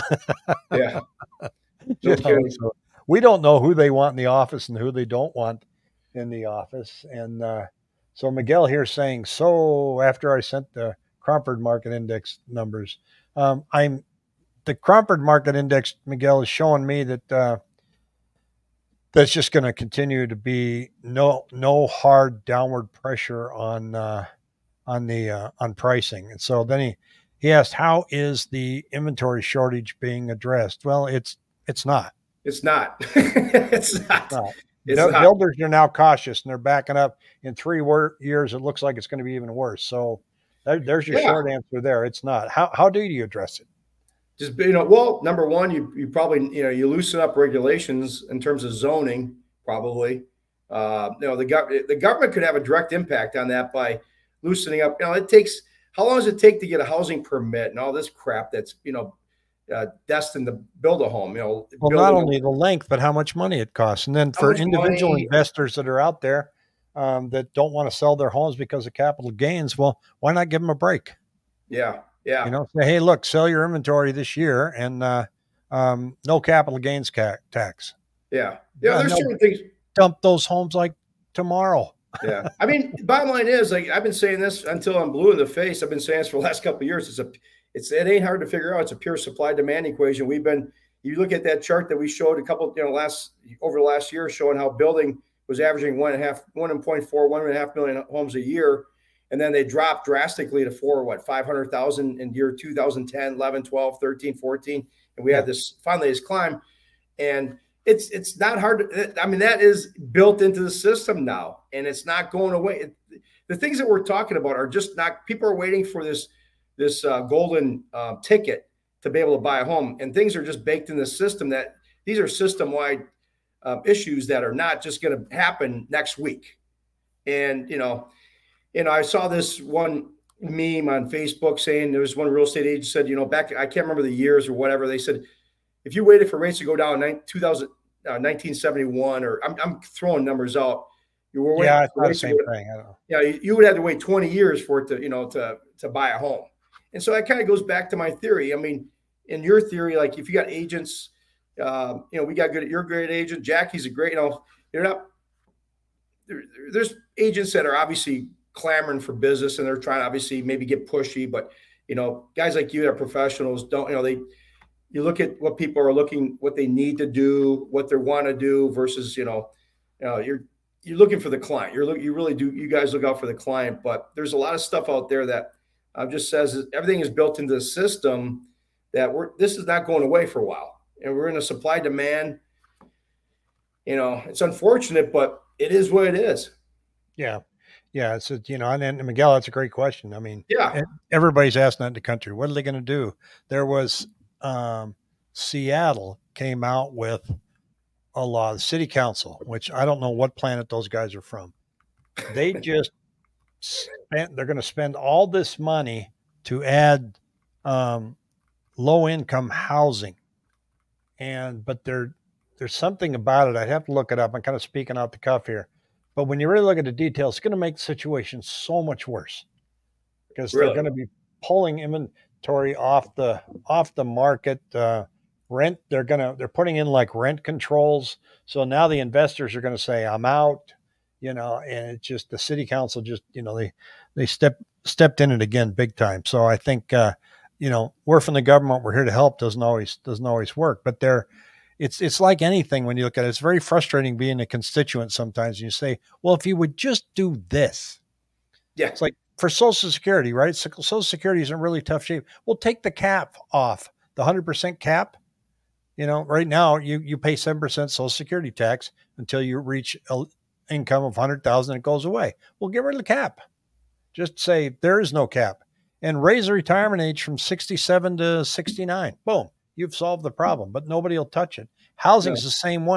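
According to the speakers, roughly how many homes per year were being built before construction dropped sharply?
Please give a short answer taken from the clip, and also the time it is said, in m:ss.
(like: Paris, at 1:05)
1.5 million, at 1:37.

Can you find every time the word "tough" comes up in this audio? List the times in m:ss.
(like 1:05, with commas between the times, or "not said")
4:11.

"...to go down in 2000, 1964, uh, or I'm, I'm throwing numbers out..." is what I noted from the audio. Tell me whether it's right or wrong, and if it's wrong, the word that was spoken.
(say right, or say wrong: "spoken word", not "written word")
wrong: "1971", not "1964".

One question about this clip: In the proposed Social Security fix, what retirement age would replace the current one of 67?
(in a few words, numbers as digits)
69.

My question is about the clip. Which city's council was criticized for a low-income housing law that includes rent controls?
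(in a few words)
Seattle.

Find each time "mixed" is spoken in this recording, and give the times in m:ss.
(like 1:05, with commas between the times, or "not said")
not said.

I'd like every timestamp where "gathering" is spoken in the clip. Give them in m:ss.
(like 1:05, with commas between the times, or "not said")
not said.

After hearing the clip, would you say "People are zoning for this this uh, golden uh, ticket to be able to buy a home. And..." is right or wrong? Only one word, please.
wrong.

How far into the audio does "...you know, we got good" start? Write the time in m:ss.
2:32.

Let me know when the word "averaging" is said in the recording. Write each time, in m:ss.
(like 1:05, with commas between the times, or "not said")
1:35.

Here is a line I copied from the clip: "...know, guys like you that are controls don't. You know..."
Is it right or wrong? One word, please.
wrong.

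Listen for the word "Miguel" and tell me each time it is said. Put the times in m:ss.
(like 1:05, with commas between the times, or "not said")
0:08, 0:16, 3:09.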